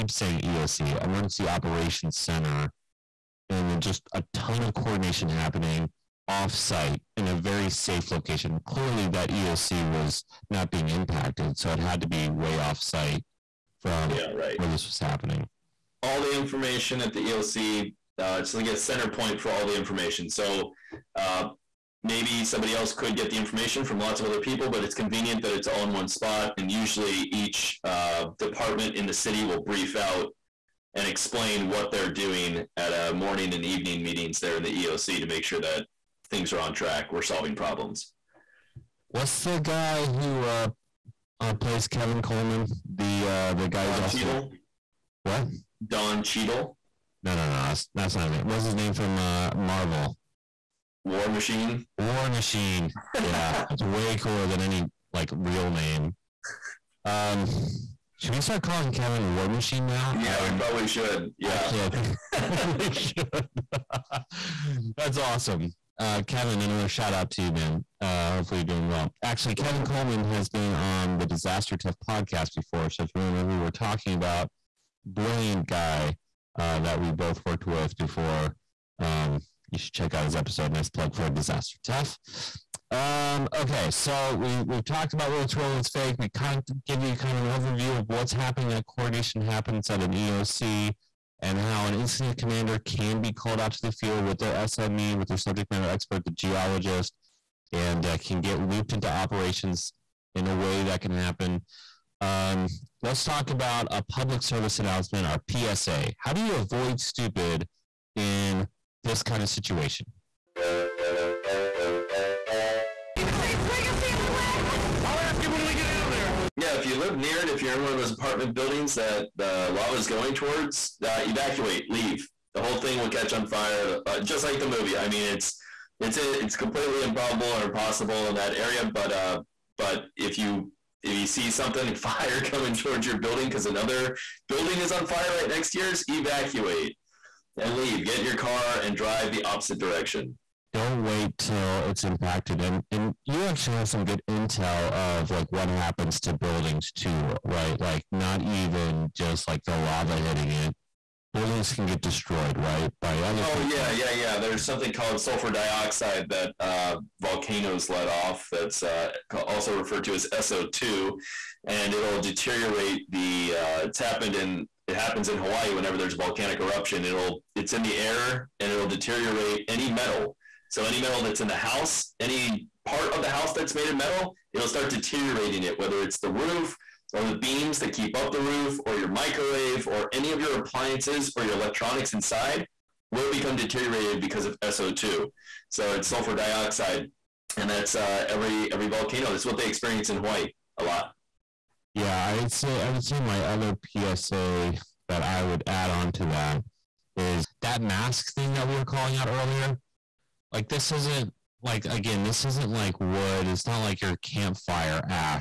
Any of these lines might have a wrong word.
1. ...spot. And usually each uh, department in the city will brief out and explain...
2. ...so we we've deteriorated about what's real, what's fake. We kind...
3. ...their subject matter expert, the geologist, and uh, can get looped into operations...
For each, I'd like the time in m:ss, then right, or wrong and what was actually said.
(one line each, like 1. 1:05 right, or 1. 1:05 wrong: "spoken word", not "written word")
1. 0:26 right
2. 1:23 wrong: "talked", not "deteriorated"
3. 1:35 right.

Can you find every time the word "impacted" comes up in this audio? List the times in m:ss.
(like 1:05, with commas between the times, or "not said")
0:10, 2:22.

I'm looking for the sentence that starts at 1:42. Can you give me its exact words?
Um, let's talk about a public service announcement, our PSA.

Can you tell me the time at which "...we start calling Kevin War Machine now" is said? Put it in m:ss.
0:58.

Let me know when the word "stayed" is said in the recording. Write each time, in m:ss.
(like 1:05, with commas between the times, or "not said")
not said.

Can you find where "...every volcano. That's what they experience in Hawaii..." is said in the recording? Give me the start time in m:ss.
3:08.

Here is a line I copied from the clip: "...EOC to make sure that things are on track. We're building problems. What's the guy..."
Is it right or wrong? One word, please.
wrong.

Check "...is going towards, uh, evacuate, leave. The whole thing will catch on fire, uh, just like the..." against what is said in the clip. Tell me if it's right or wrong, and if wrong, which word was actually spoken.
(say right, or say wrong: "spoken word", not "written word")
right.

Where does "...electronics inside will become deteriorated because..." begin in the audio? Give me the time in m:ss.
3:01.